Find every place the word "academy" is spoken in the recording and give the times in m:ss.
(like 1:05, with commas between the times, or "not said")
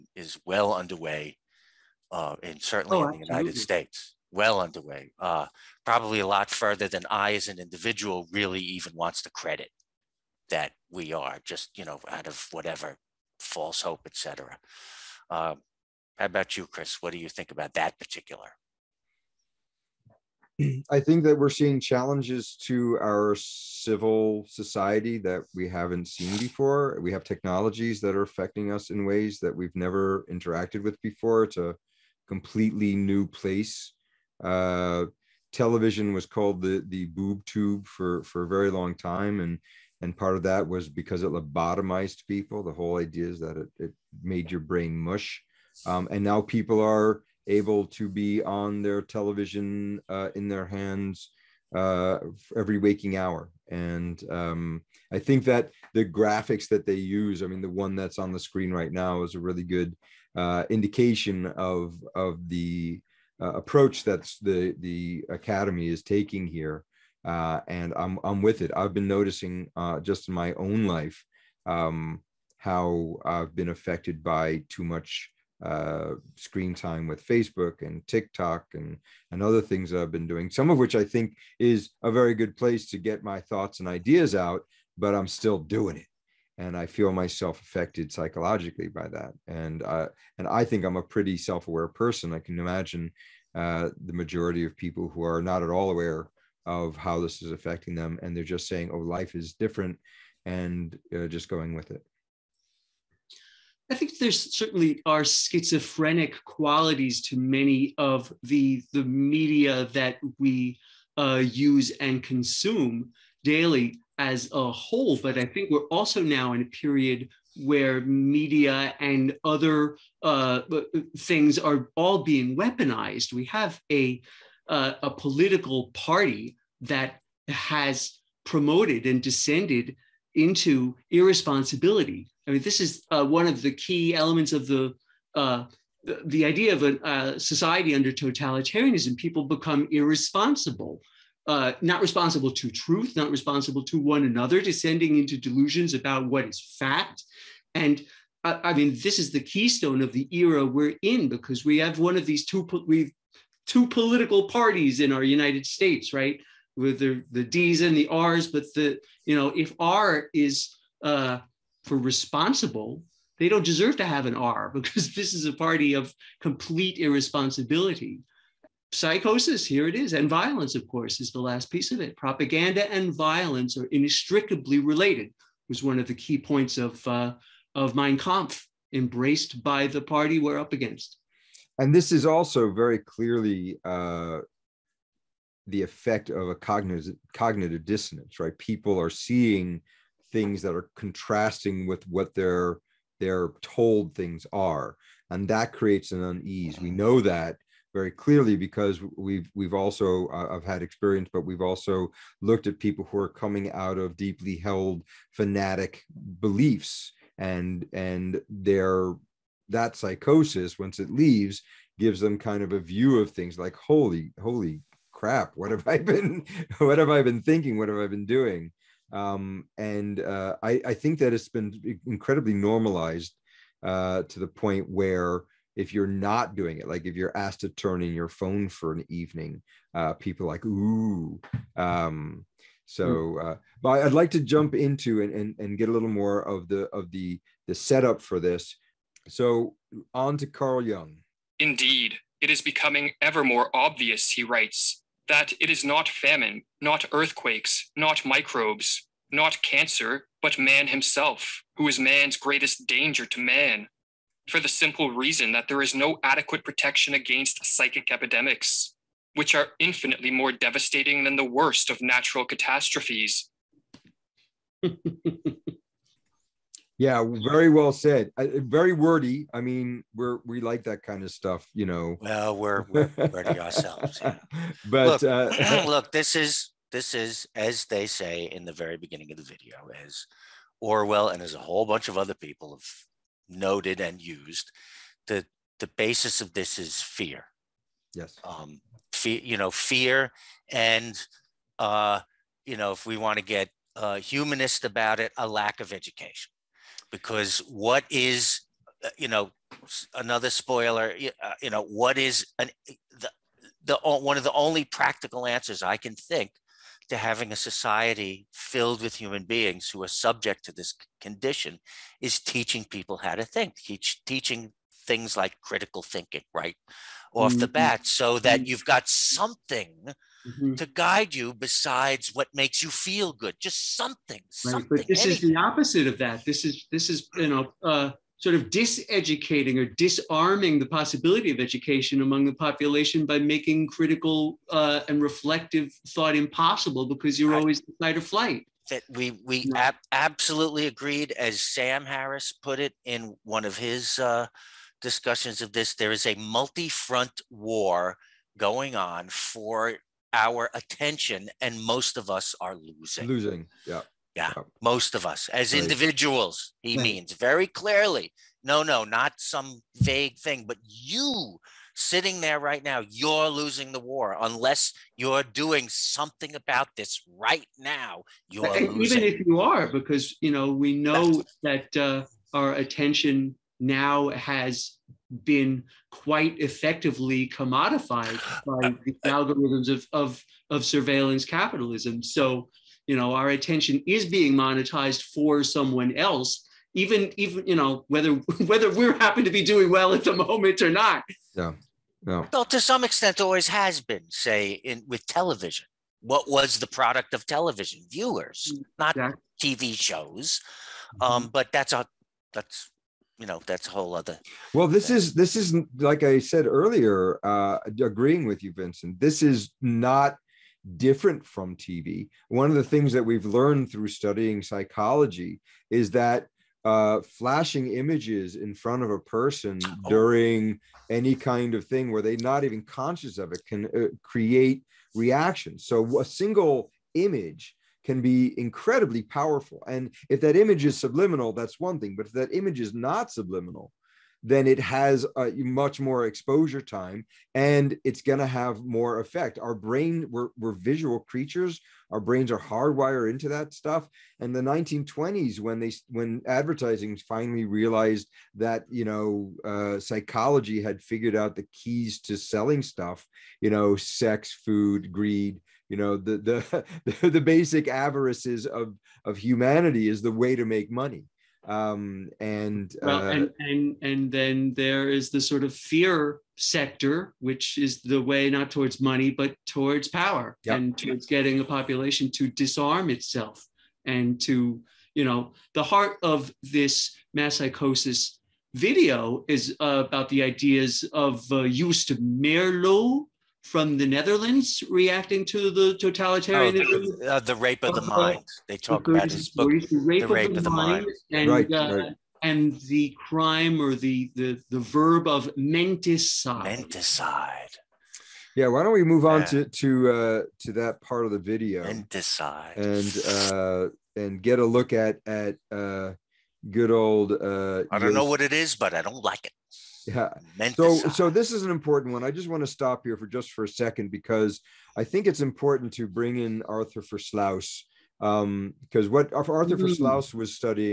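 1:05.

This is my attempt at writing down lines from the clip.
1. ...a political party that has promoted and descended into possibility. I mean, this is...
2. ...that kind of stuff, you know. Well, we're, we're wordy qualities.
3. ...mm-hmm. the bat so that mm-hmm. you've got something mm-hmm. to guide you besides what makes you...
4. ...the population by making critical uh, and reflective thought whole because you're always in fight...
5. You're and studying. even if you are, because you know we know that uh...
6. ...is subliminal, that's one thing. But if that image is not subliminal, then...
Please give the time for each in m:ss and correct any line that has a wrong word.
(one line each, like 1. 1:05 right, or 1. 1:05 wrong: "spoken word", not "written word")
1. 2:05 wrong: "irresponsibility", not "possibility"
2. 4:30 wrong: "ourselves", not "qualities"
3. 5:17 right
4. 5:32 wrong: "impossible", not "whole"
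5. 6:08 wrong: "losing", not "studying"
6. 7:10 right.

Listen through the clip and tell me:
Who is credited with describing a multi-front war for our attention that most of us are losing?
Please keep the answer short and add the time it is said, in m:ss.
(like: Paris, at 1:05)
Sam Harris, at 5:41.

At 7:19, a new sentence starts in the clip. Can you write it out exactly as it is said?
Our brain, we're, we're visual creatures.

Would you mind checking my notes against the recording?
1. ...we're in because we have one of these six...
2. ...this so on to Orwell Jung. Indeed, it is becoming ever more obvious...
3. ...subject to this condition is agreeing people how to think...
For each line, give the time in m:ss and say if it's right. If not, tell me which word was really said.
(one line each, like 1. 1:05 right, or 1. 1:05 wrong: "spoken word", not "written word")
1. 2:30 wrong: "two", not "six"
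2. 3:58 wrong: "Carl", not "Orwell"
3. 5:10 wrong: "teaching", not "agreeing".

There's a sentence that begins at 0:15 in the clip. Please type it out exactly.
Uh, um, how about you, Chris?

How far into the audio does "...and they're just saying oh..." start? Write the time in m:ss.
1:38.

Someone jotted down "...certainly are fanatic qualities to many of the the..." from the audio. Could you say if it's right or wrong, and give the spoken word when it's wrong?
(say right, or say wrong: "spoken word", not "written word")
wrong: "schizophrenic", not "fanatic".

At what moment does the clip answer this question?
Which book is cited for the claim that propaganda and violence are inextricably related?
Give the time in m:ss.
2:57.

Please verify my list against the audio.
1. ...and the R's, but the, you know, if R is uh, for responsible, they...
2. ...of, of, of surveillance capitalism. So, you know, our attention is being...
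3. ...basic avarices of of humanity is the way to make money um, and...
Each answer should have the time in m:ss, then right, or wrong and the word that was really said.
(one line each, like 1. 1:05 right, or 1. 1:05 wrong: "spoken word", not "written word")
1. 2:37 right
2. 6:19 right
3. 7:37 right.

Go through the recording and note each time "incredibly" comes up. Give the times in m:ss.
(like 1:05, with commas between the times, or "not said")
3:42, 7:08.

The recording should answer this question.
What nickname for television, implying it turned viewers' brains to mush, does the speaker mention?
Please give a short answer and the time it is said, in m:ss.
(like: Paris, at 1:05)
the boob tube, at 0:36.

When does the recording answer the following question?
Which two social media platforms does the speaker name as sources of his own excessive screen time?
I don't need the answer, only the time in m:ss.
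1:17.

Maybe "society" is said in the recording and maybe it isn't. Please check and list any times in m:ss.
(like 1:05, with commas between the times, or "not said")
0:24, 2:17, 5:07.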